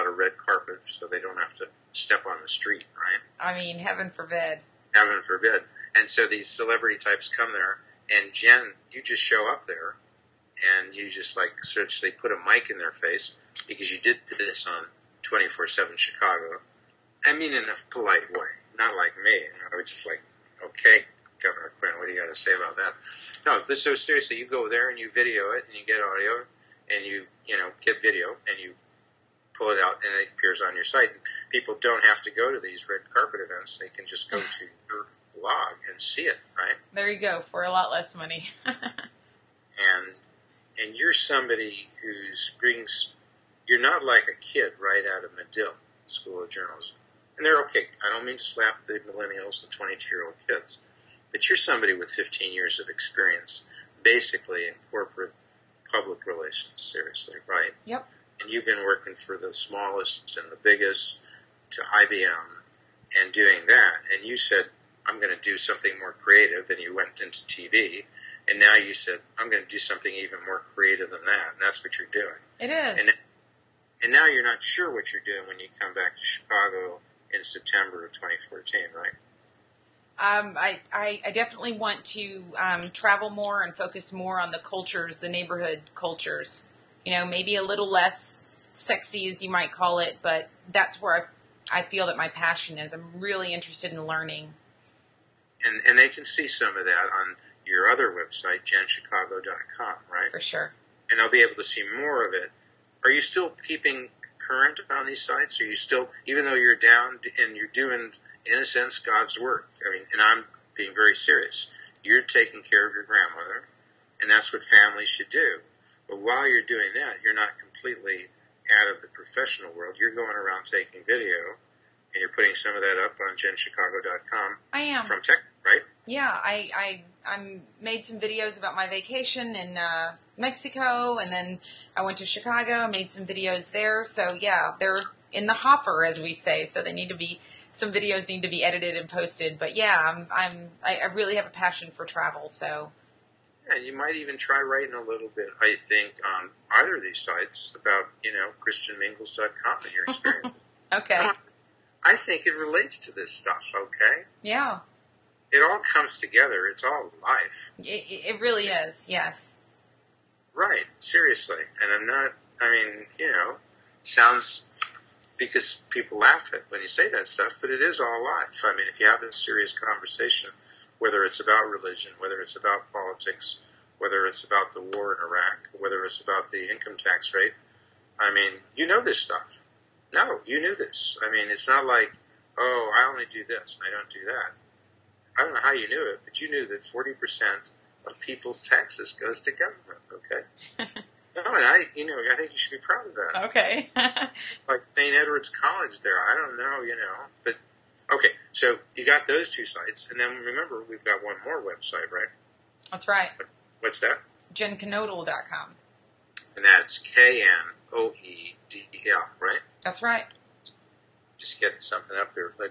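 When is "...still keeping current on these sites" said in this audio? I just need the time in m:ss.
1:43.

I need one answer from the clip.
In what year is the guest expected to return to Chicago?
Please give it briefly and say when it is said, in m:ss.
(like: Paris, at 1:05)
2014, at 1:18.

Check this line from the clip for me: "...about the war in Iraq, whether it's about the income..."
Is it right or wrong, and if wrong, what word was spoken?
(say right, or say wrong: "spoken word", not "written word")
right.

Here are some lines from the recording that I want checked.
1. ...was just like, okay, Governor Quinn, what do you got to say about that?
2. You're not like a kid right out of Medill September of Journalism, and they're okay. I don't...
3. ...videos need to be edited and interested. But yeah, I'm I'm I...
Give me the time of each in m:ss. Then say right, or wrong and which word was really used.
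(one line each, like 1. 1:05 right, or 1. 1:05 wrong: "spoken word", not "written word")
1. 0:19 right
2. 0:43 wrong: "School", not "September"
3. 2:17 wrong: "posted", not "interested".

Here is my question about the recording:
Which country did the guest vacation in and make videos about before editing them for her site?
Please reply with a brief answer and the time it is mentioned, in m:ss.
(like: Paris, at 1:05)
Mexico, at 2:10.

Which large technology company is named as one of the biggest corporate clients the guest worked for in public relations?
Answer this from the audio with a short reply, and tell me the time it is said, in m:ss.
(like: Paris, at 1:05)
IBM, at 1:01.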